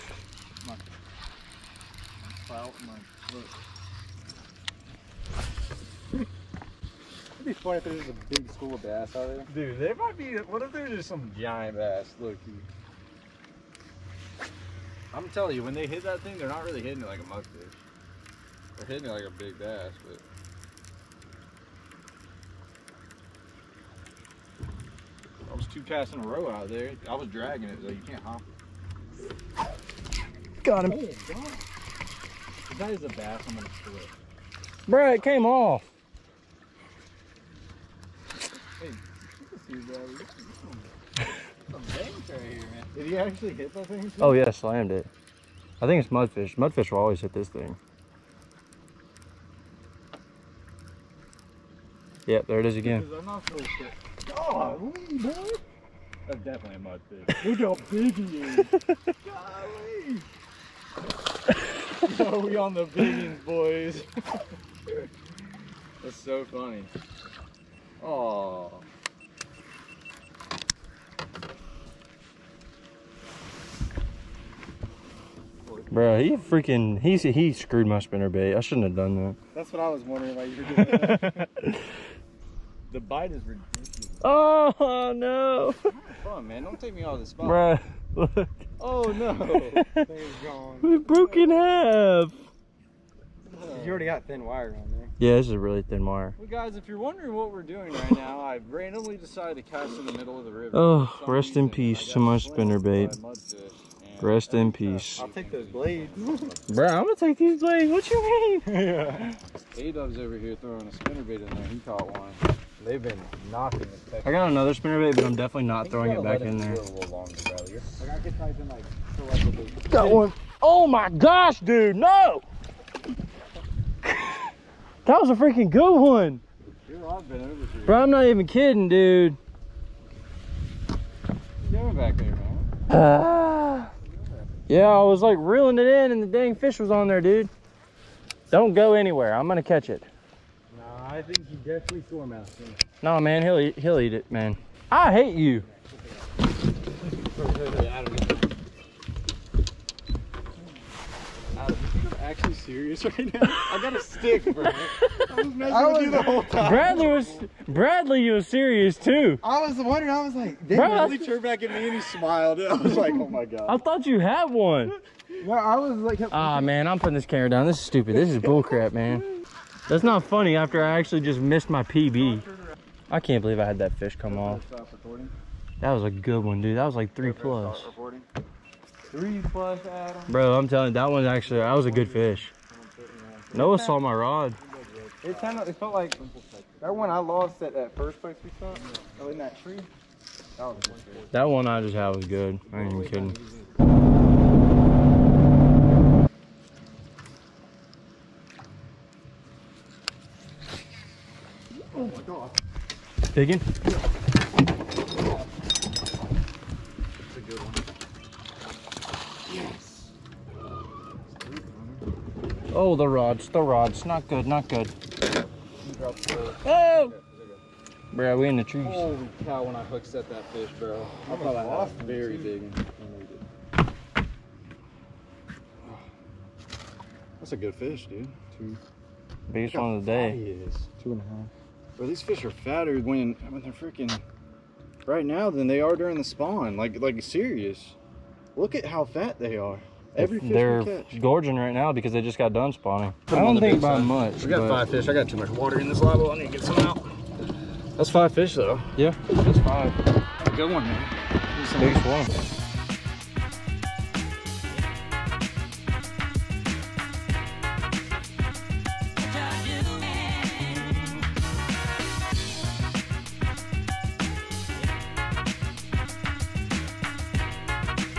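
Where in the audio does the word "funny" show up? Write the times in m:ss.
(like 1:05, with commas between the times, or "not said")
0:07, 1:06, 2:50.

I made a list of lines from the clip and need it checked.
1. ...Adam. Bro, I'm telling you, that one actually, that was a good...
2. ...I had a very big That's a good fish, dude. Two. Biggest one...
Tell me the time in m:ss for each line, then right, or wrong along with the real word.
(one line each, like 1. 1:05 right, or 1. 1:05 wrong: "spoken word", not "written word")
1. 2:59 right
2. 3:41 right.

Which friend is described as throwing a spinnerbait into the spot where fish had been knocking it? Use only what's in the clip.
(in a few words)
A-Dub.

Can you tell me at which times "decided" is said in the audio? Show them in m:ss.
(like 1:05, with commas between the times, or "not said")
1:39.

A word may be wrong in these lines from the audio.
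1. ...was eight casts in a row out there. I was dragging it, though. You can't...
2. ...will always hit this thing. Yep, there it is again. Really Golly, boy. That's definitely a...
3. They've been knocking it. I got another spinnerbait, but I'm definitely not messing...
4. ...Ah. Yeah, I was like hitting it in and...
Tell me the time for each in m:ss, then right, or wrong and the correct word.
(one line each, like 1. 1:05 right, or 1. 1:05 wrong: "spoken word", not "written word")
1. 0:25 wrong: "two", not "eight"
2. 0:46 right
3. 1:52 wrong: "throwing", not "messing"
4. 2:13 wrong: "reeling", not "hitting".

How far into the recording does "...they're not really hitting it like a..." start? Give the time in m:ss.
0:16.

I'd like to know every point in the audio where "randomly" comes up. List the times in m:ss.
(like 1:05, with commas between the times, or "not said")
1:38.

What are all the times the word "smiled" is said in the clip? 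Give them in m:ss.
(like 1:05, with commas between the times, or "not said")
2:42.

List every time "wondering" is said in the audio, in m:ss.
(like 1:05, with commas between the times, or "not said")
1:20, 1:36, 2:39.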